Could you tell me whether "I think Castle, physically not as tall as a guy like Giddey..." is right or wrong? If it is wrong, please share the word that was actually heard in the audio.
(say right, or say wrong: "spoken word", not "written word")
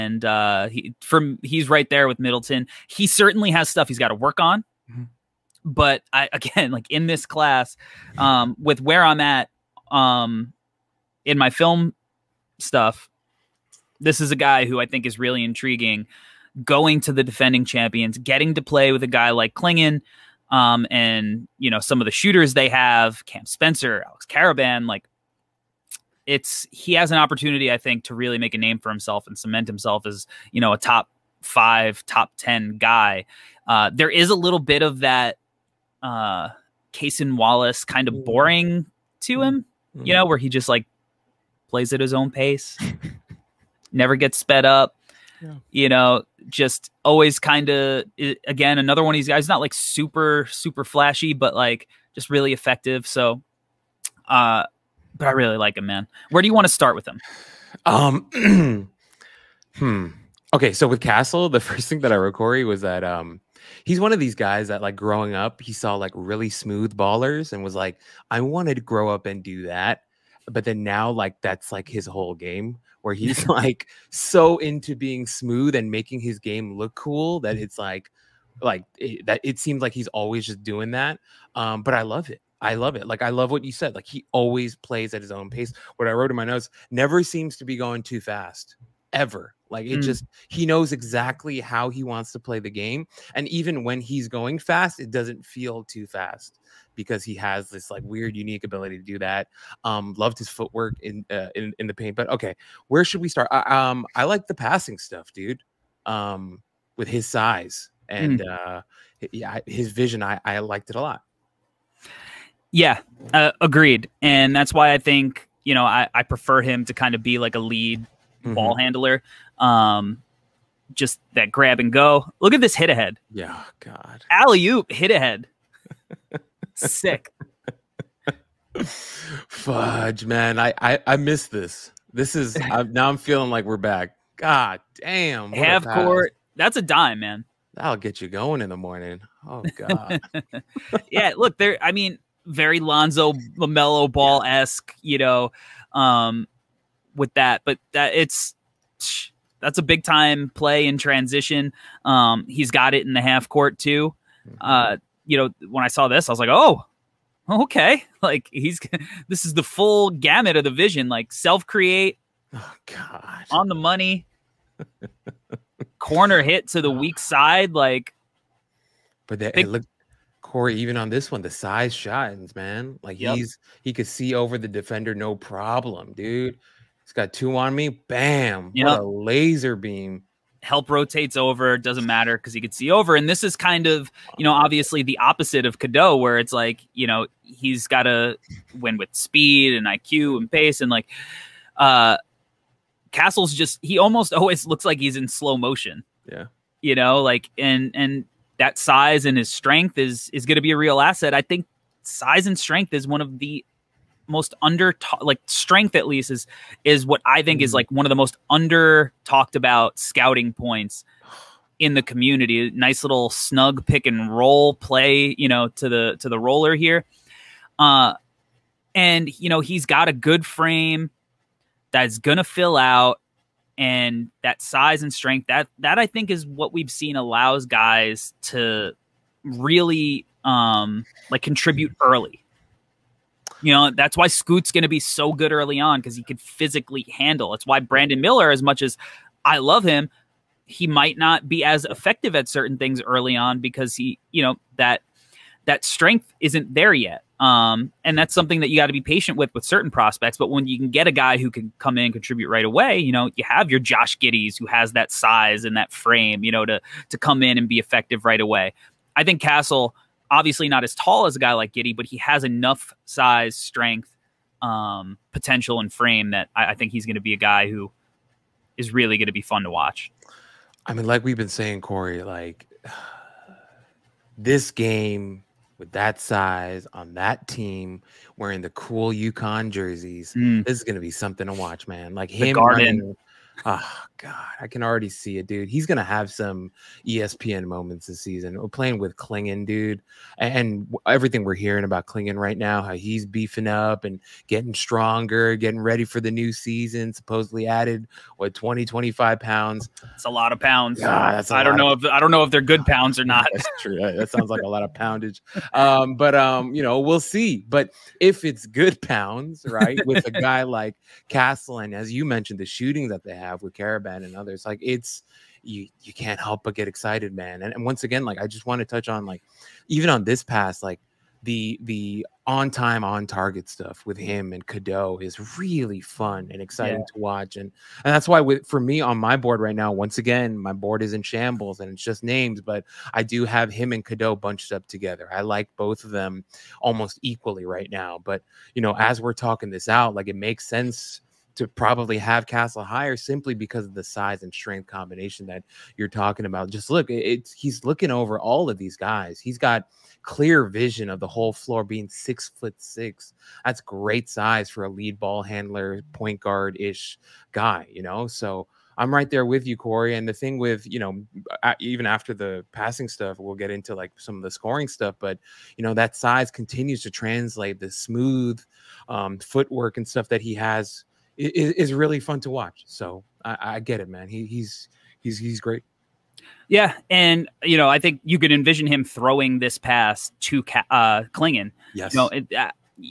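wrong: "obviously", not "physically".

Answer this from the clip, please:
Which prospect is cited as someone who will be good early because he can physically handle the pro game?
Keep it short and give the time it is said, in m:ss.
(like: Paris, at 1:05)
Scoot, at 3:54.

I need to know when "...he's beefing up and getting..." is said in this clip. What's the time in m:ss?
4:52.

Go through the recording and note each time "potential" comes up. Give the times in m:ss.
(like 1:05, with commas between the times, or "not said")
4:25.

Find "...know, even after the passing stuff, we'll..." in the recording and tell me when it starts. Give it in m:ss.
6:00.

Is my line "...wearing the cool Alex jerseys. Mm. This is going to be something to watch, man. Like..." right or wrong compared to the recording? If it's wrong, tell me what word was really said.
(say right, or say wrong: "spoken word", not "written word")
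wrong: "UConn", not "Alex".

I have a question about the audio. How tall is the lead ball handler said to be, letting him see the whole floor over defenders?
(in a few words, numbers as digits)
6 foot 6.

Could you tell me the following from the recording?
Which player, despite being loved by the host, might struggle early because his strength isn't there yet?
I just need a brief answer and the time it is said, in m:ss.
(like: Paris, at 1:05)
Brandon Miller, at 3:57.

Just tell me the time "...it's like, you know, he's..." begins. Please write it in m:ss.
3:06.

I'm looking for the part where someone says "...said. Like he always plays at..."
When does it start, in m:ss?
1:23.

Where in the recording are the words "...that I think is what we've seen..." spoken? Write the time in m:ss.
3:45.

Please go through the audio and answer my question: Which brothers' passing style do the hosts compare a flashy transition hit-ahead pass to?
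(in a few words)
Lonzo LaMelo Ball.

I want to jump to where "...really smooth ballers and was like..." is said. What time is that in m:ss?
1:06.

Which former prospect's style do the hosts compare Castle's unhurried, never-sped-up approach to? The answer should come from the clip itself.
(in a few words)
Cason Wallace.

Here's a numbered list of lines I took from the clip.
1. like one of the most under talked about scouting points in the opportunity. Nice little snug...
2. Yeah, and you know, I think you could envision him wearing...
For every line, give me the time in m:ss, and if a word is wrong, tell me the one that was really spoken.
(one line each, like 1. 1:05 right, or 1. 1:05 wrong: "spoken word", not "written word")
1. 3:27 wrong: "community", not "opportunity"
2. 6:16 wrong: "throwing", not "wearing".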